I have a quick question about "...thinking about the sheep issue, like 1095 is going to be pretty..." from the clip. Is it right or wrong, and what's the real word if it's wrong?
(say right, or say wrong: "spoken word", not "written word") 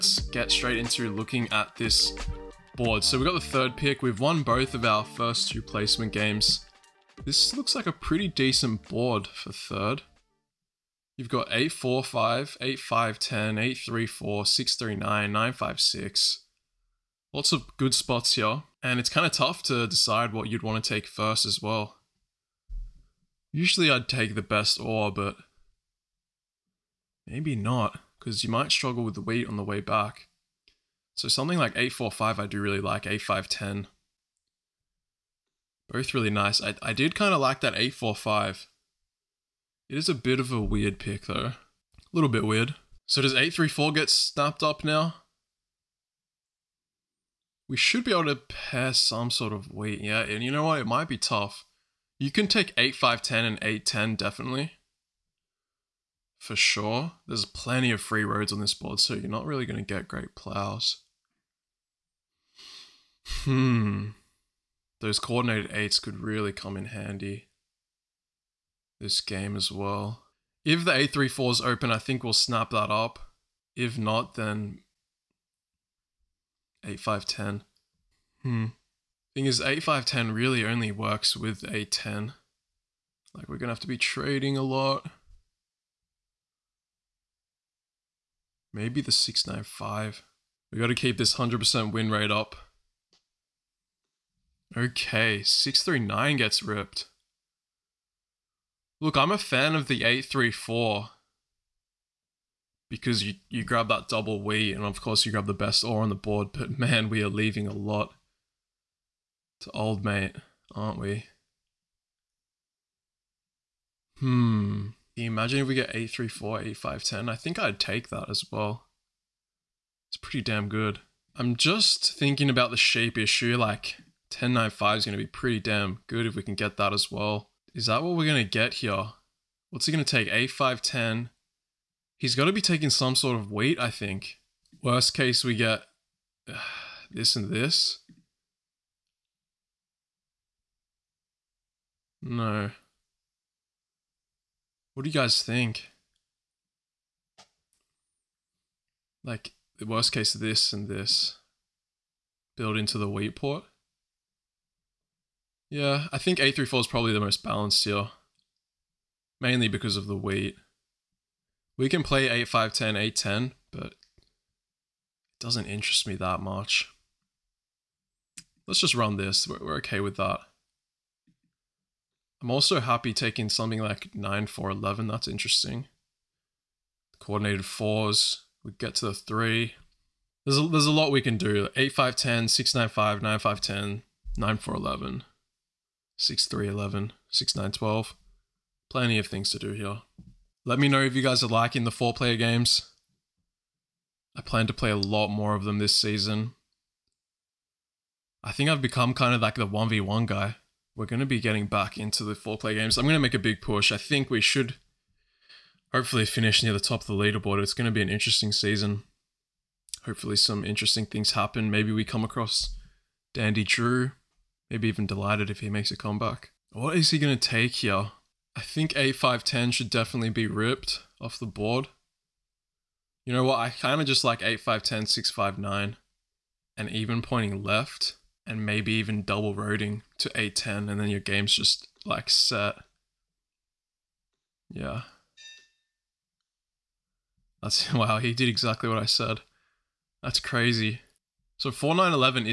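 right.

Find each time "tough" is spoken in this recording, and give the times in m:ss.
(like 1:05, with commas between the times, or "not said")
0:19, 0:51.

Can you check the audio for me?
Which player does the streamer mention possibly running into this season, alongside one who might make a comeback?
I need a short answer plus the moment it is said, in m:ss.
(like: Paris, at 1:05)
Dandy Drew, at 3:33.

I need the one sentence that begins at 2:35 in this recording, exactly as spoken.
Yeah, I think 834 is probably the most balanced here.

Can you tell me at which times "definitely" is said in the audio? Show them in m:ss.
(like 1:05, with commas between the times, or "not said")
0:54, 3:39.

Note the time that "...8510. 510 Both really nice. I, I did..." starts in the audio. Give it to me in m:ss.
0:33.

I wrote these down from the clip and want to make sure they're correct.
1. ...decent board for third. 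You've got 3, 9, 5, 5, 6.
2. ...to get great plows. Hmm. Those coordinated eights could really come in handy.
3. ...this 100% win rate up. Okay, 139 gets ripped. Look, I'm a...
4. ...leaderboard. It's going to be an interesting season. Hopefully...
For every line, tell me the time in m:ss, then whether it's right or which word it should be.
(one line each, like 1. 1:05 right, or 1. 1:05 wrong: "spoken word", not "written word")
1. 0:08 wrong: "9", not "5"
2. 0:59 right
3. 1:31 wrong: "639", not "139"
4. 3:27 right.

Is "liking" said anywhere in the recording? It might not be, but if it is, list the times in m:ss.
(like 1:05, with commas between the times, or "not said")
3:11.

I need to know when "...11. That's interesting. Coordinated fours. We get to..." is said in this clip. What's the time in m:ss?
2:54.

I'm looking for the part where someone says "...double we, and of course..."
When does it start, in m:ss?
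1:44.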